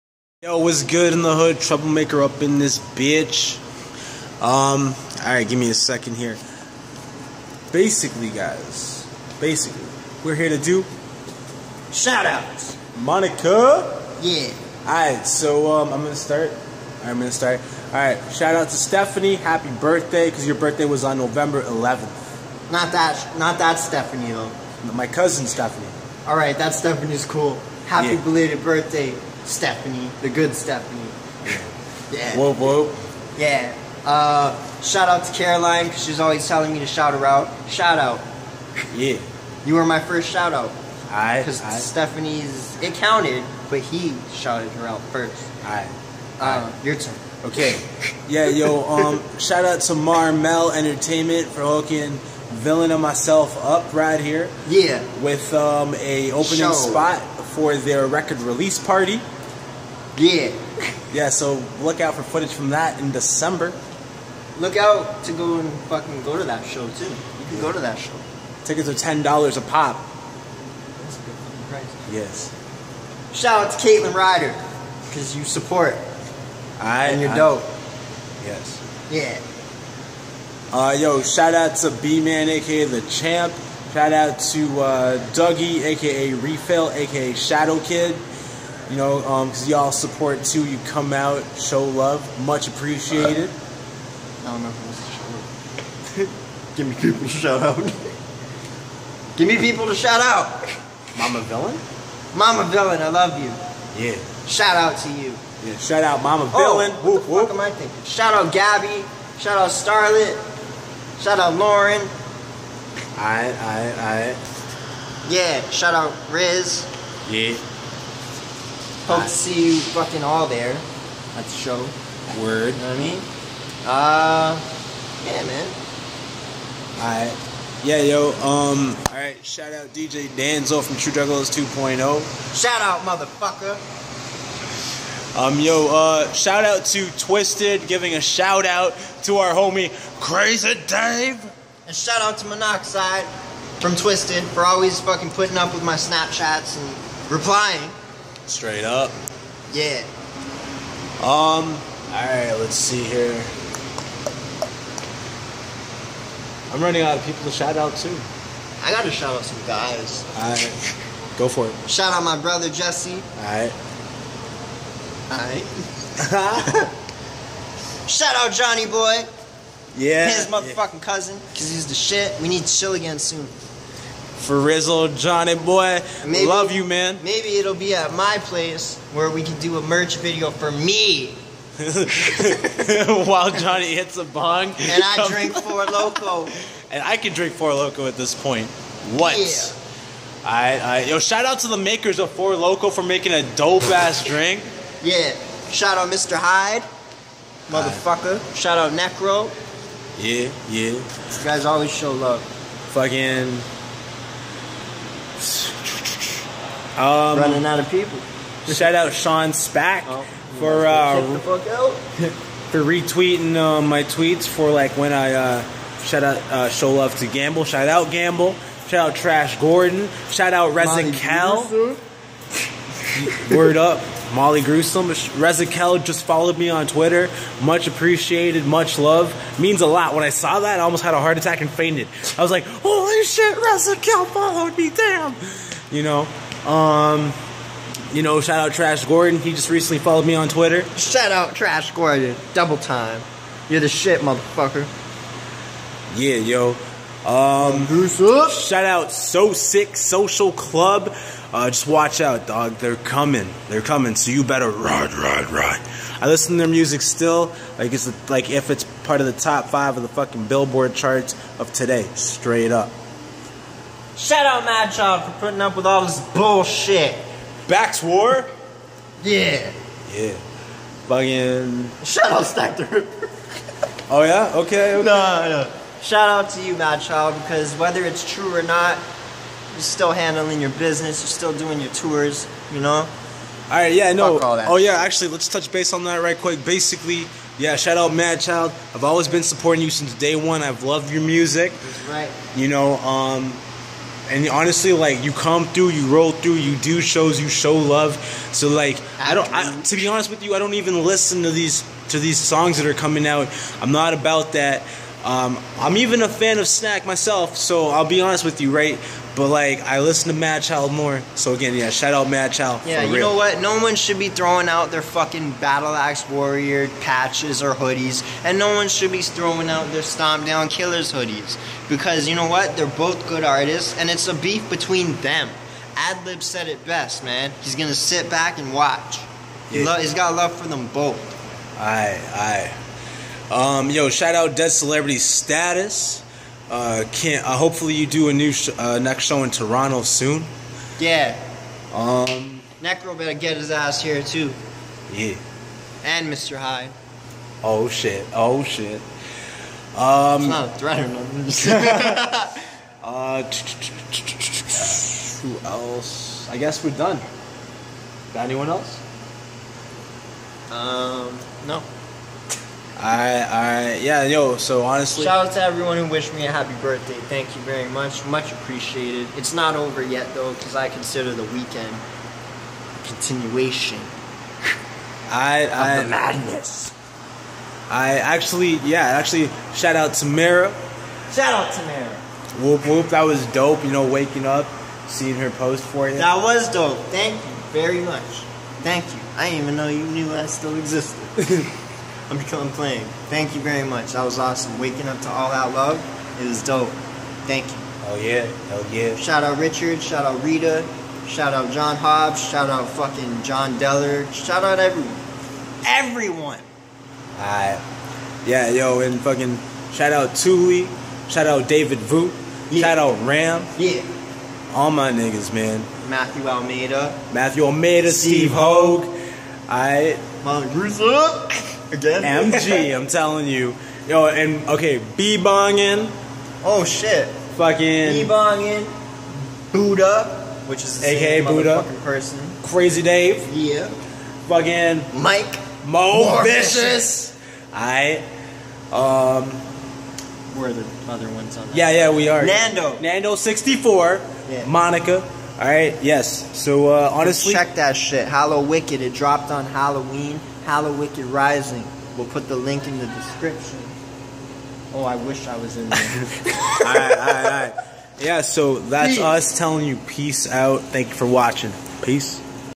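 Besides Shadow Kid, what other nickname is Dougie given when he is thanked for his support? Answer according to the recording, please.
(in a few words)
Refill.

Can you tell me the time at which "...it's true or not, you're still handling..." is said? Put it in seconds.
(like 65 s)
278 s.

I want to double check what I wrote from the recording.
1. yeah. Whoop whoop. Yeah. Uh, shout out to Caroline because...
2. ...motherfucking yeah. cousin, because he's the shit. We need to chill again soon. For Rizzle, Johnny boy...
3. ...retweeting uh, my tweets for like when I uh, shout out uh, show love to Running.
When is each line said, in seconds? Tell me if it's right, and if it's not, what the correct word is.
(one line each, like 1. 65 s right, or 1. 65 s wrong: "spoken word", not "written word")
1. 32 s right
2. 170 s right
3. 212 s wrong: "Gamble", not "Running".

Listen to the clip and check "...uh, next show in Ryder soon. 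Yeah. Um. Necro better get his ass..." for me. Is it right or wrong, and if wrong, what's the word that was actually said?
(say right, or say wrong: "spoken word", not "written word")
wrong: "Toronto", not "Ryder".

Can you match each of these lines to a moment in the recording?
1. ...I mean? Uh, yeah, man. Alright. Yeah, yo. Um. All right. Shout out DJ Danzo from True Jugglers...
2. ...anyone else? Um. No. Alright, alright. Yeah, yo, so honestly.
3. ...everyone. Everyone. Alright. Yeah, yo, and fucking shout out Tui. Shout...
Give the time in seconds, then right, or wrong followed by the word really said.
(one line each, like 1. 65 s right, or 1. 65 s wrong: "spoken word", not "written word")
1. 122 s right
2. 358 s right
3. 404 s right.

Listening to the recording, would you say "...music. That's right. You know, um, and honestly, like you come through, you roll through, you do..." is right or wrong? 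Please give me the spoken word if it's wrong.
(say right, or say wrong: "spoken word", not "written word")
right.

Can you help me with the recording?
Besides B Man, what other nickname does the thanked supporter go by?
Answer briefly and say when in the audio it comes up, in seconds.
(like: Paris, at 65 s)
the Champ, at 82 s.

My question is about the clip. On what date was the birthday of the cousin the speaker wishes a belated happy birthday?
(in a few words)
November 11.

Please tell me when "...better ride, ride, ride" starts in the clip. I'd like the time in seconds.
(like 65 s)
254 s.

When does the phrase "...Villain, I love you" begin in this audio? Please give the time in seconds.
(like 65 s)
102 s.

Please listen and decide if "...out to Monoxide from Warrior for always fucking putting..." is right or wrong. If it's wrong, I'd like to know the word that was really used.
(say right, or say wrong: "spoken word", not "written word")
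wrong: "Twiztid", not "Warrior".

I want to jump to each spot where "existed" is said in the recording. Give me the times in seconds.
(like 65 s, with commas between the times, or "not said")
390 s.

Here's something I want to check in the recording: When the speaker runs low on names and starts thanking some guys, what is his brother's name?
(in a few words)
Jesse.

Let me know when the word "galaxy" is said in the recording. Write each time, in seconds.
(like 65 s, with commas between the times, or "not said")
not said.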